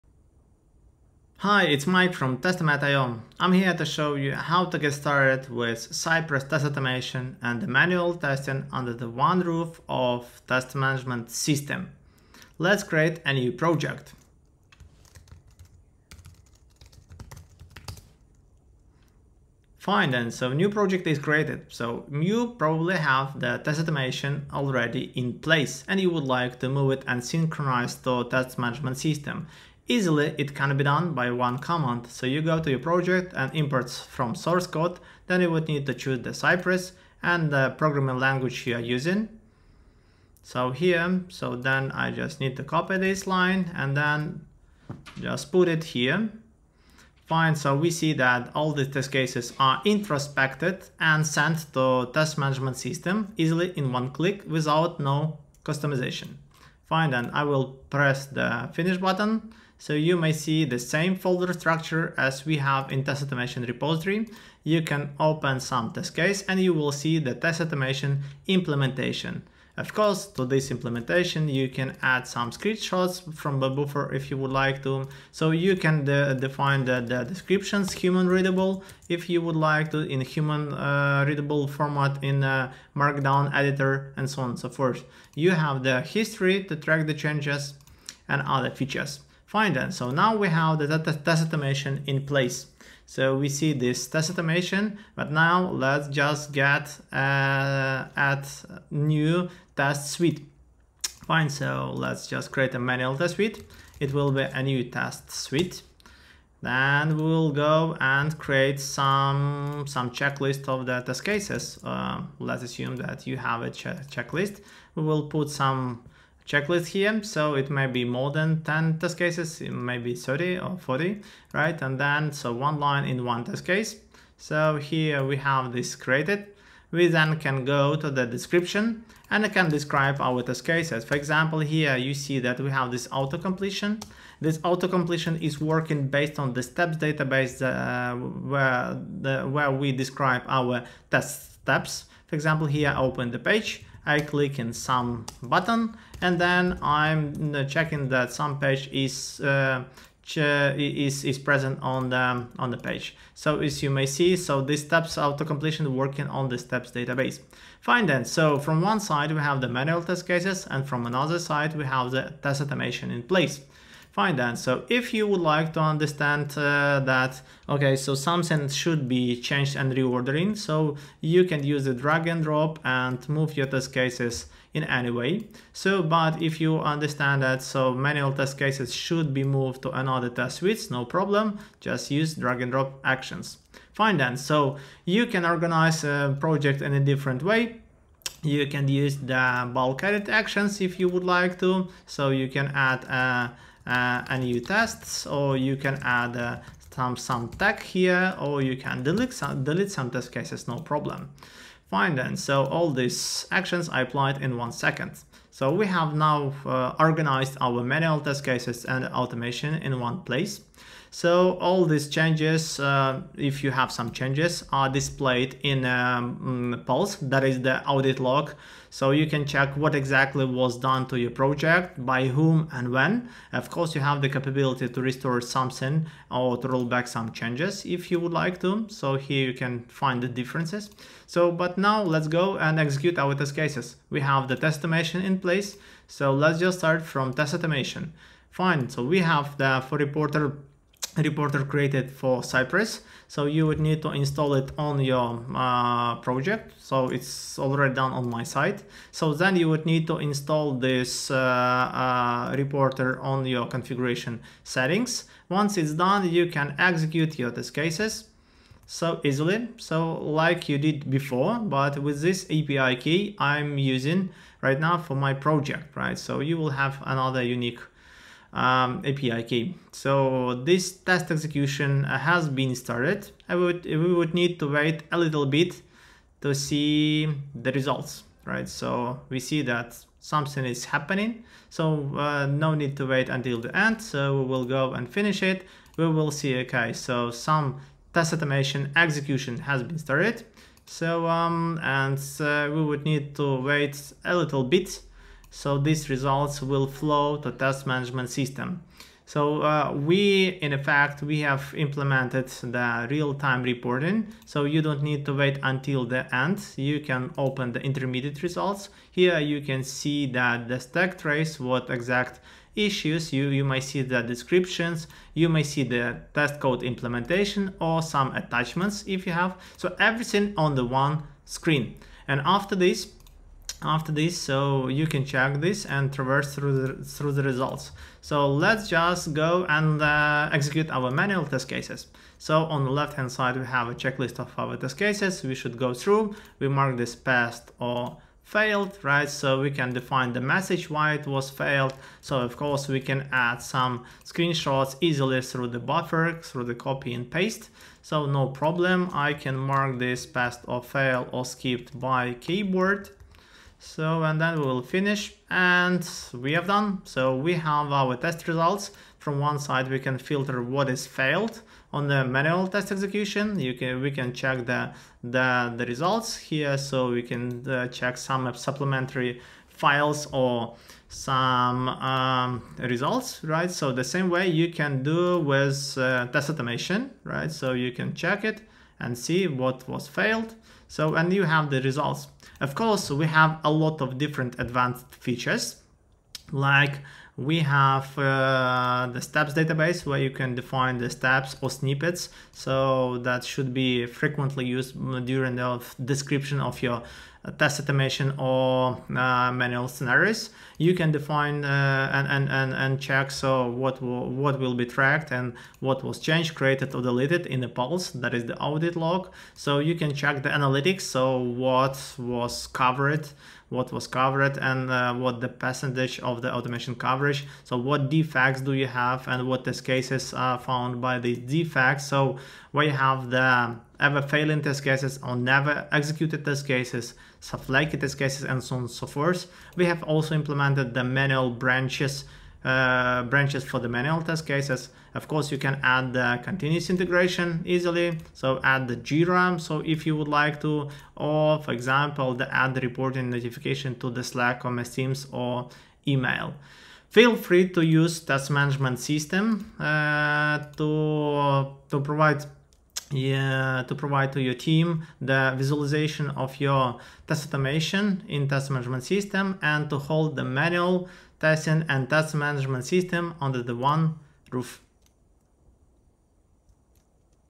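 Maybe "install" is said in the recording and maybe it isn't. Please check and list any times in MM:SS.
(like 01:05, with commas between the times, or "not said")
04:04, 04:10.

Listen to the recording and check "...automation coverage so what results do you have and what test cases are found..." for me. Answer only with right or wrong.
wrong.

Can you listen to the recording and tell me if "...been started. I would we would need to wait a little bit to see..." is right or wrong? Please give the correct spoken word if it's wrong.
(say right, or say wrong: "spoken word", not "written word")
right.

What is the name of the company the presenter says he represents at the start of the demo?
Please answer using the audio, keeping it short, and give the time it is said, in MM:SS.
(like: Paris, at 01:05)
Testomat.io, at 00:02.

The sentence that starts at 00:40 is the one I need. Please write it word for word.
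So here, so then I just need to copy this line and then just put it here.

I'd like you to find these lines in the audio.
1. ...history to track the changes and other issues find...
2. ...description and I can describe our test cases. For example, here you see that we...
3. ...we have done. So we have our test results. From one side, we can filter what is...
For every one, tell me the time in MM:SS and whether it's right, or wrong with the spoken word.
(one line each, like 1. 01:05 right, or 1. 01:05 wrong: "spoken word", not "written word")
1. 01:26 wrong: "features", not "issues"
2. 02:08 right
3. 05:56 right.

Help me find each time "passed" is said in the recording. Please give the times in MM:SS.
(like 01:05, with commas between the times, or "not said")
05:37, 05:50.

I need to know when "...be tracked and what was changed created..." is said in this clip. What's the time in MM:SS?
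06:44.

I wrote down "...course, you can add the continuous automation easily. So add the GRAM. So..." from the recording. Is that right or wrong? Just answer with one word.
wrong.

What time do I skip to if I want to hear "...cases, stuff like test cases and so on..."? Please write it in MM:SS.
07:06.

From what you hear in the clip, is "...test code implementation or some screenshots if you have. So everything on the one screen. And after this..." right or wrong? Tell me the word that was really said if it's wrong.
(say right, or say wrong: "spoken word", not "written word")
wrong: "attachments", not "screenshots".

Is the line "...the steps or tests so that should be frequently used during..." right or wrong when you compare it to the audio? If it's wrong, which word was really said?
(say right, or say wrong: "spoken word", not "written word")
wrong: "snippets", not "tests".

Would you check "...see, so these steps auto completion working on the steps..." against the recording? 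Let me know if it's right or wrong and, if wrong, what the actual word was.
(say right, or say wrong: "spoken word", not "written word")
right.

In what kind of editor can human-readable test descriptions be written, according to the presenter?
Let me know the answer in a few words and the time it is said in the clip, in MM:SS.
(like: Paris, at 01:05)
Markdown editor, at 01:22.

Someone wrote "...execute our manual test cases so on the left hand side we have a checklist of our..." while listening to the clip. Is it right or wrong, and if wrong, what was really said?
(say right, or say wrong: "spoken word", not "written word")
right.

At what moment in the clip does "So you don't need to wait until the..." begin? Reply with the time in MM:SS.
05:04.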